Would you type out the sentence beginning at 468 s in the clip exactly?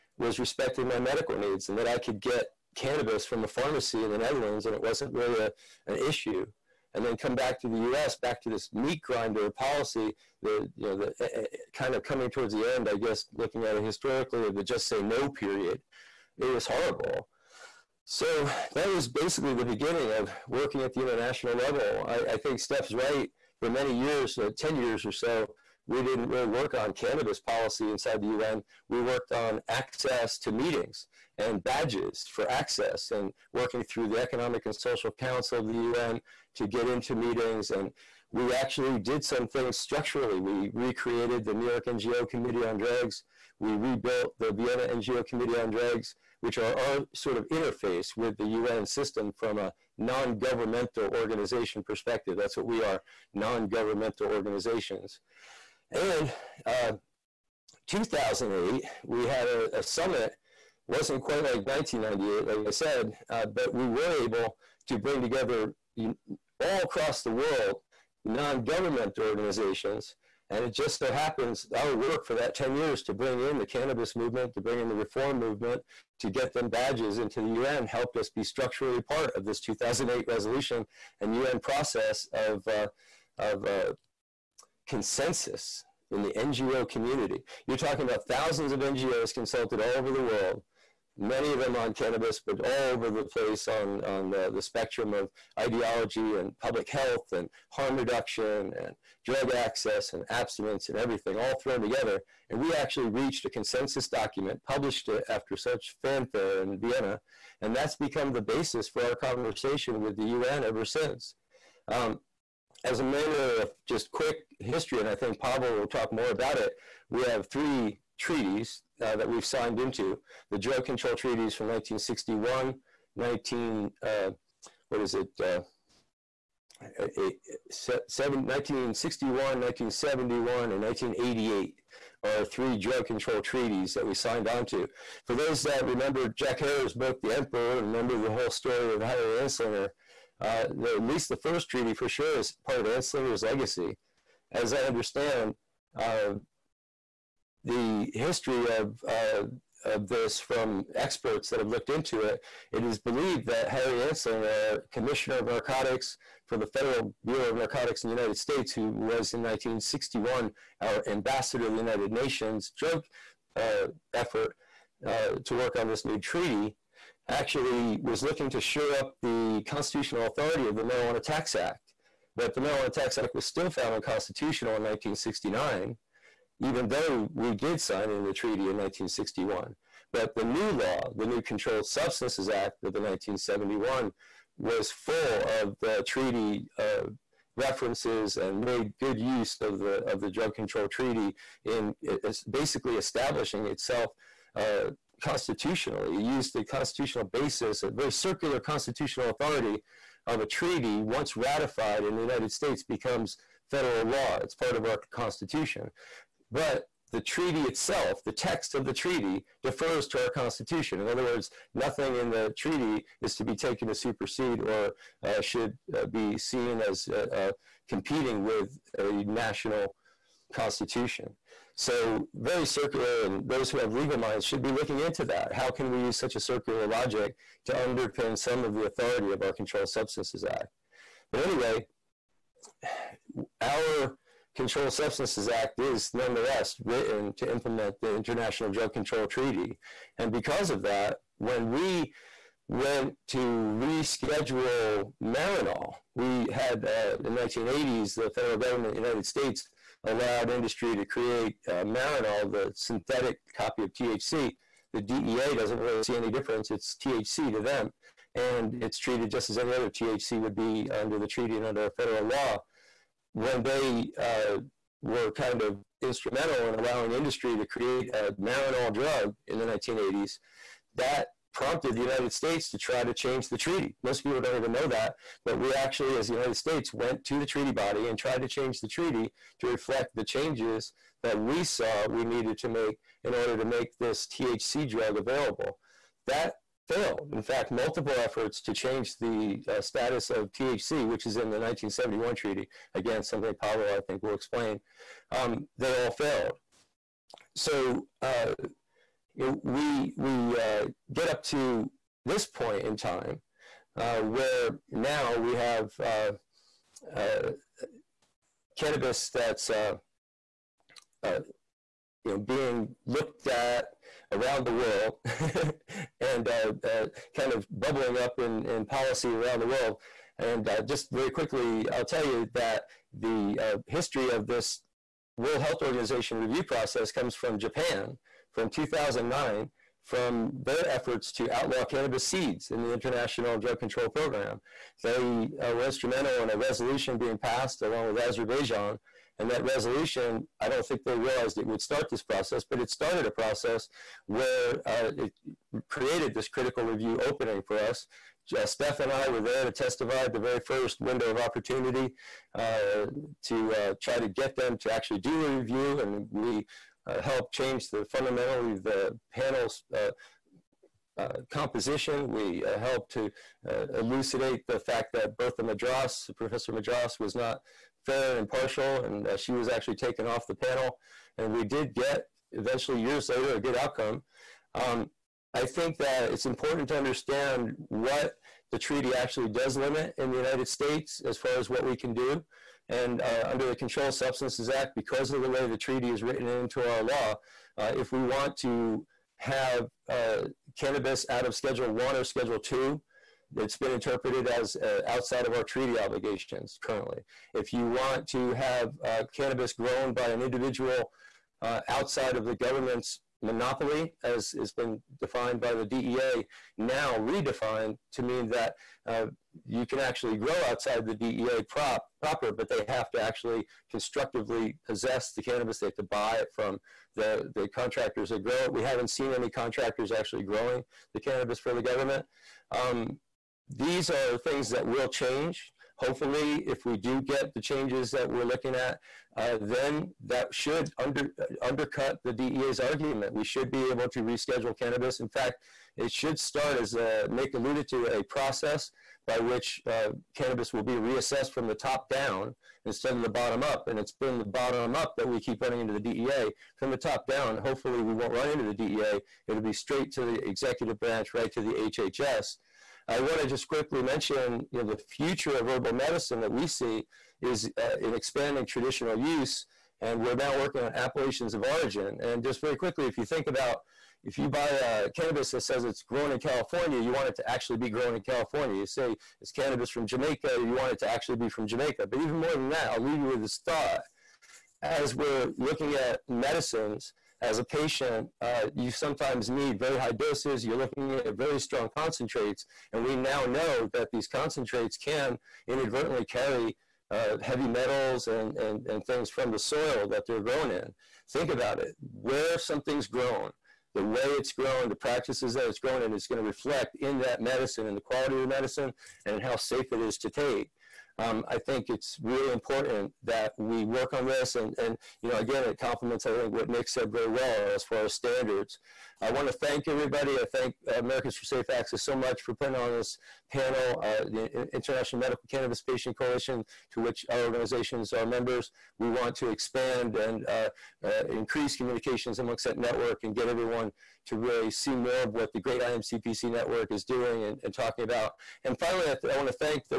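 You say it's cannabis from Jamaica, you want it to actually be from Jamaica.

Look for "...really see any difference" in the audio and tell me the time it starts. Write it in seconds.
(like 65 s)
255 s.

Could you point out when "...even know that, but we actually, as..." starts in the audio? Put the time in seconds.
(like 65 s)
274 s.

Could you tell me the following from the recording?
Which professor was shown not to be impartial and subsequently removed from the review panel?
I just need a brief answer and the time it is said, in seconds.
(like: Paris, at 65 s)
Bertha Madras, at 365 s.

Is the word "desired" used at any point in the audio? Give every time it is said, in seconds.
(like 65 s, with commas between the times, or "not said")
not said.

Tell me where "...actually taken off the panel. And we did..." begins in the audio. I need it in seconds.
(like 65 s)
369 s.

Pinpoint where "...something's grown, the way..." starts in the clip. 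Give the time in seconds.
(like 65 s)
492 s.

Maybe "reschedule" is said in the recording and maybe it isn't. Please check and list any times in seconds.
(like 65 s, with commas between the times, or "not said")
243 s, 434 s.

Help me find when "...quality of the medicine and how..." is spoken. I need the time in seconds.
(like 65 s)
497 s.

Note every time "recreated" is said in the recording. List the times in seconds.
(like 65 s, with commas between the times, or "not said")
40 s.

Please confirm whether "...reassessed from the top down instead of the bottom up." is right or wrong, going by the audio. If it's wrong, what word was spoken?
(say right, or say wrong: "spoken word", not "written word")
right.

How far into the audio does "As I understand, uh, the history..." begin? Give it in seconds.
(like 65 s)
144 s.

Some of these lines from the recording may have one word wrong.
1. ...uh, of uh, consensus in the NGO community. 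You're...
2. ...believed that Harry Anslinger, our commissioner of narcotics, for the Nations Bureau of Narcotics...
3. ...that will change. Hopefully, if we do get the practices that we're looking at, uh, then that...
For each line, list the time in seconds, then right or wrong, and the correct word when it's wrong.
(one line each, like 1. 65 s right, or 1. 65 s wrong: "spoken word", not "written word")
1. 82 s right
2. 152 s wrong: "Federal", not "Nations"
3. 424 s wrong: "changes", not "practices".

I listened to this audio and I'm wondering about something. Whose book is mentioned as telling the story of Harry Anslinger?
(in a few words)
Jack Herer.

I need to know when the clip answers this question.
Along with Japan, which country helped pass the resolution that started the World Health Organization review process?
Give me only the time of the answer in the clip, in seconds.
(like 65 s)
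338 s.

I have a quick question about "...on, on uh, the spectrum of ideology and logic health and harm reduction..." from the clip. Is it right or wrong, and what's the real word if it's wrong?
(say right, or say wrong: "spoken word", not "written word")
wrong: "public", not "logic".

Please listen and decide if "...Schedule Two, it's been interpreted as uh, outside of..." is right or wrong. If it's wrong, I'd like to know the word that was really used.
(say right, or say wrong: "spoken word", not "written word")
right.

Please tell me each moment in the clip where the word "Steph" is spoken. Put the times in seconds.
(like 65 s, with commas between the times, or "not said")
22 s, 348 s.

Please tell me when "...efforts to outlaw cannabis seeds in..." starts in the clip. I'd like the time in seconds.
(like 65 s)
330 s.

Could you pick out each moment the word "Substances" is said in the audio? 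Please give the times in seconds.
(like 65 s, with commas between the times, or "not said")
181 s, 229 s, 234 s, 384 s.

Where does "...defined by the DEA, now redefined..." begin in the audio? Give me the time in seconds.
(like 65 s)
405 s.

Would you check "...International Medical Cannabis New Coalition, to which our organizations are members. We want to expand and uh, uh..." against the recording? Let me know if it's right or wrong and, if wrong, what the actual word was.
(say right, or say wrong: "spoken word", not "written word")
wrong: "Patient", not "New".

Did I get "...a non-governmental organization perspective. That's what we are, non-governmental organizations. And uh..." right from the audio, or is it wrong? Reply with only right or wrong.
right.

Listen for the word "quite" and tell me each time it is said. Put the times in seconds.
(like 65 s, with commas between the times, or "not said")
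61 s.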